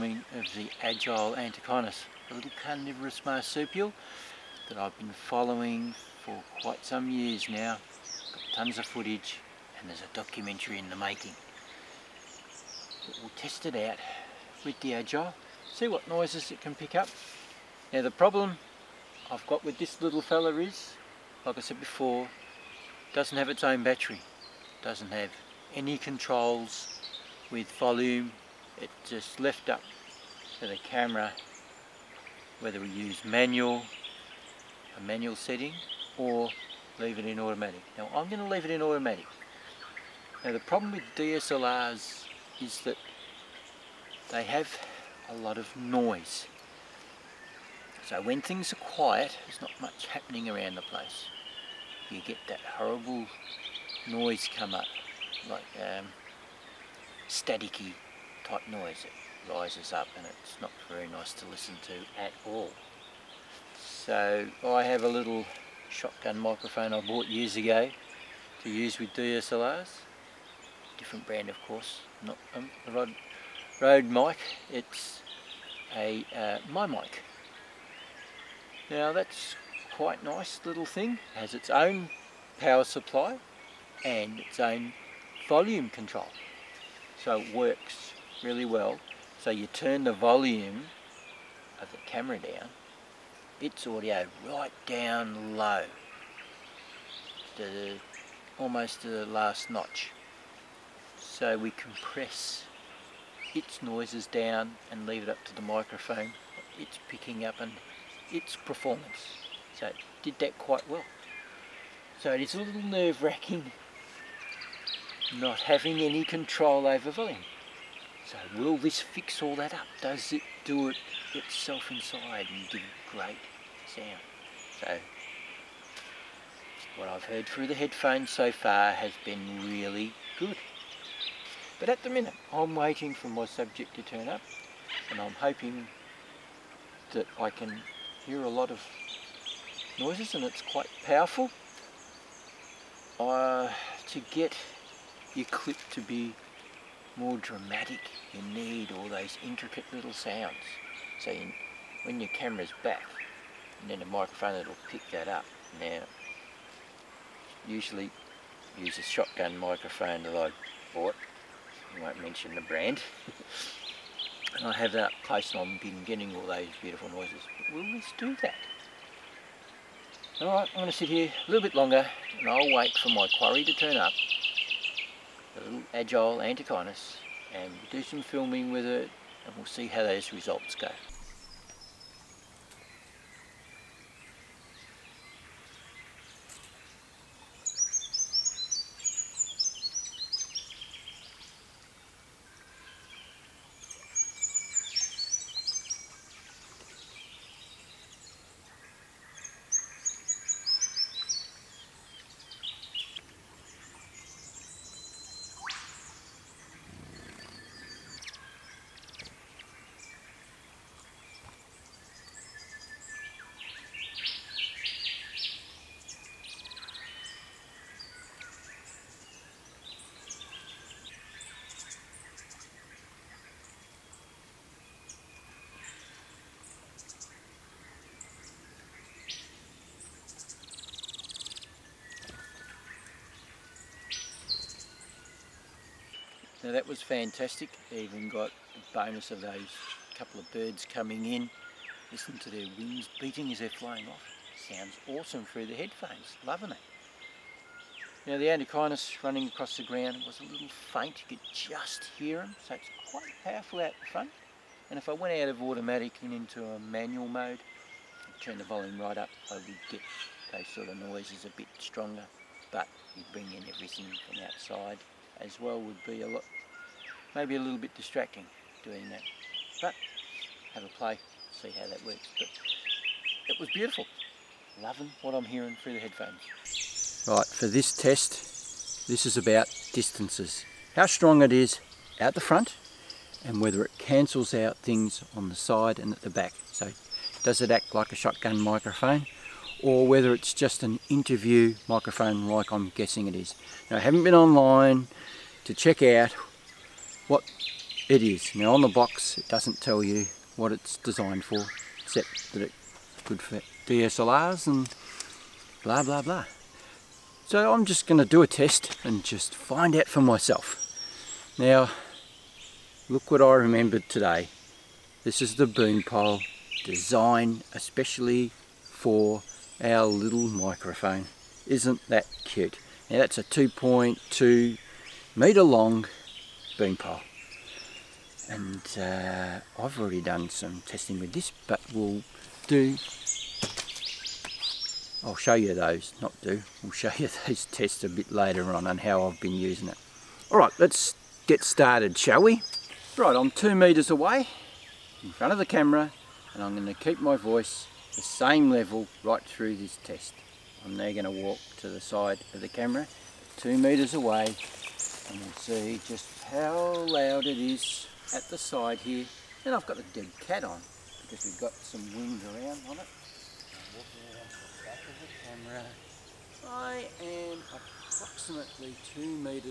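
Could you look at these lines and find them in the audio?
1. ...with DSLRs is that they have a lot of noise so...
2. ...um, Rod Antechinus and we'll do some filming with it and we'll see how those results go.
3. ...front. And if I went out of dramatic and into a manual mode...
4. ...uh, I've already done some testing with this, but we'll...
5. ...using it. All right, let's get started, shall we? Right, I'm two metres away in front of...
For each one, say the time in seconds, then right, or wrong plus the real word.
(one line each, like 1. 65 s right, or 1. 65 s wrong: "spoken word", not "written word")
1. 40 s right
2. 175 s wrong: "Agile", not "Rod"
3. 254 s wrong: "automatic", not "dramatic"
4. 328 s right
5. 339 s right.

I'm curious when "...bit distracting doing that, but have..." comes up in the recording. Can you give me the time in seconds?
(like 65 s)
267 s.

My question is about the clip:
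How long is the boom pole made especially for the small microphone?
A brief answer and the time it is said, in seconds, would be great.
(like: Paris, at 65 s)
2.2 meters, at 323 s.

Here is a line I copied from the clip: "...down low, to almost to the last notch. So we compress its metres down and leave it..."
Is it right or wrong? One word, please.
wrong.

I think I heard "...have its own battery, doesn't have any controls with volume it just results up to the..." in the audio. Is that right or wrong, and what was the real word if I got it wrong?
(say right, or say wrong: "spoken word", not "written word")
wrong: "lifts", not "results".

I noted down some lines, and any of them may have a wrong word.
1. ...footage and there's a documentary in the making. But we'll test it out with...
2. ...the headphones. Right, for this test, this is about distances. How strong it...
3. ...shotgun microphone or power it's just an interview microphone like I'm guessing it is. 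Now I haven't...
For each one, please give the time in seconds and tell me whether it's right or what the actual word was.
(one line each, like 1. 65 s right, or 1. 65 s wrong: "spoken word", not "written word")
1. 8 s right
2. 275 s right
3. 288 s wrong: "whether", not "power".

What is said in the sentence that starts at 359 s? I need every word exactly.
And I've got the dead cat on because we've got some wind around on it.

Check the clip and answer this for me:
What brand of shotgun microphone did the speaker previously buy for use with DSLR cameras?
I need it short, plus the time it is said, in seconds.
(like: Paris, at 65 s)
My Mic, at 76 s.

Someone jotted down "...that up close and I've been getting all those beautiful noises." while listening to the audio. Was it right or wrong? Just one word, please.
right.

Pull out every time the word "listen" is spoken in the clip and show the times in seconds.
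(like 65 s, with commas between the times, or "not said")
61 s, 242 s.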